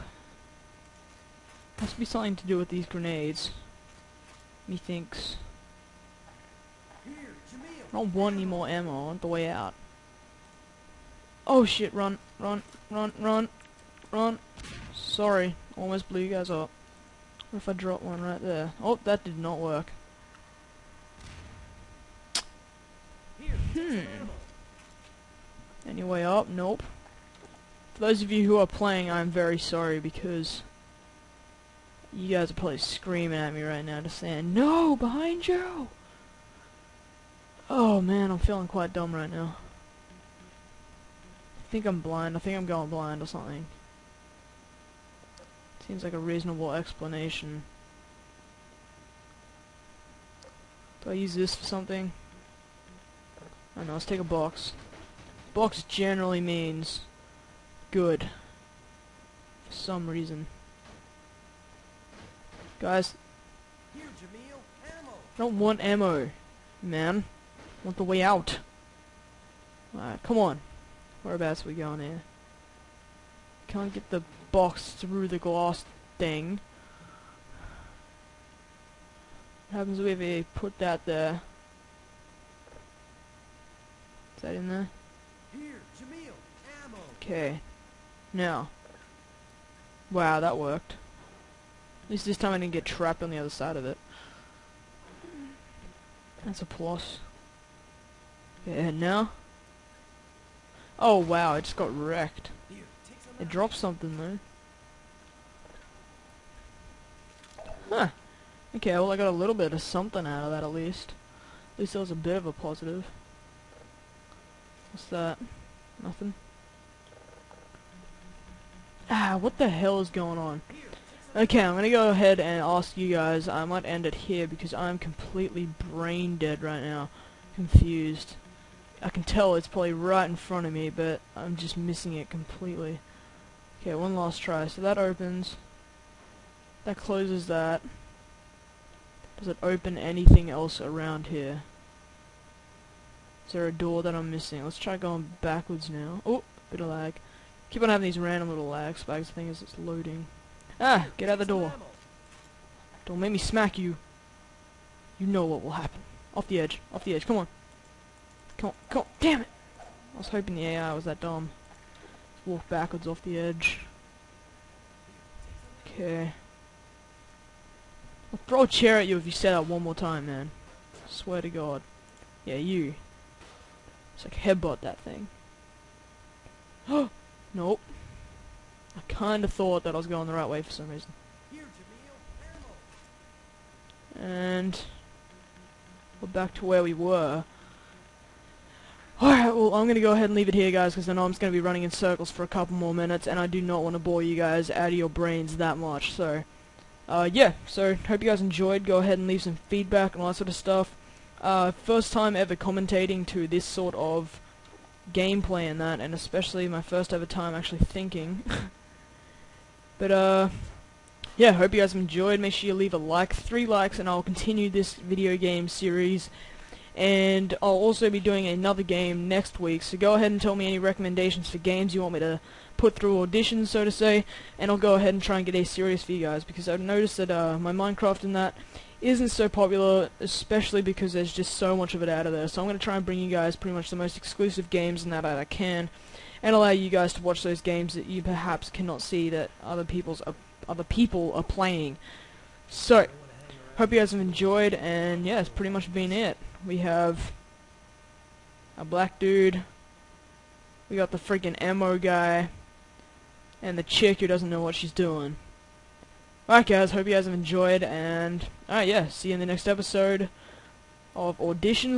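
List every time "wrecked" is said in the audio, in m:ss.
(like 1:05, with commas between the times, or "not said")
1:41.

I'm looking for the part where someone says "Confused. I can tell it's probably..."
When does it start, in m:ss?
2:07.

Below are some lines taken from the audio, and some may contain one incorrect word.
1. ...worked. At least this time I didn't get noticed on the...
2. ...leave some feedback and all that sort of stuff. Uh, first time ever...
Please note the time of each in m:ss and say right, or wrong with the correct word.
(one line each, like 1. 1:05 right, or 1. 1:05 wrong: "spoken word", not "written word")
1. 1:30 wrong: "trapped", not "noticed"
2. 3:19 right.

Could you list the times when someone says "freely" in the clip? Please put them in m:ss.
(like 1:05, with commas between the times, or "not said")
not said.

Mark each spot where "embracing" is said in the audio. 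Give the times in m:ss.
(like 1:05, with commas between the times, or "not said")
not said.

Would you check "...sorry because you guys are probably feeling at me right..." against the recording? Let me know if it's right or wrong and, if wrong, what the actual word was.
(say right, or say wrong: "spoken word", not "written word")
wrong: "screaming", not "feeling".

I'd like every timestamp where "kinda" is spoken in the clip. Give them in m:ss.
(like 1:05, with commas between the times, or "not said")
2:59.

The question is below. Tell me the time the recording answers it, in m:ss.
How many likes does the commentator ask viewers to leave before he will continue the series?
3:33.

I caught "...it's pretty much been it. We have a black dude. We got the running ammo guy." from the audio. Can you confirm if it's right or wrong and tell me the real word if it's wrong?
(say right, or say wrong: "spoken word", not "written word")
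wrong: "freaking", not "running".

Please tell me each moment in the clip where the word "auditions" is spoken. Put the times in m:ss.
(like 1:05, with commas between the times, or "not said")
3:43, 4:21.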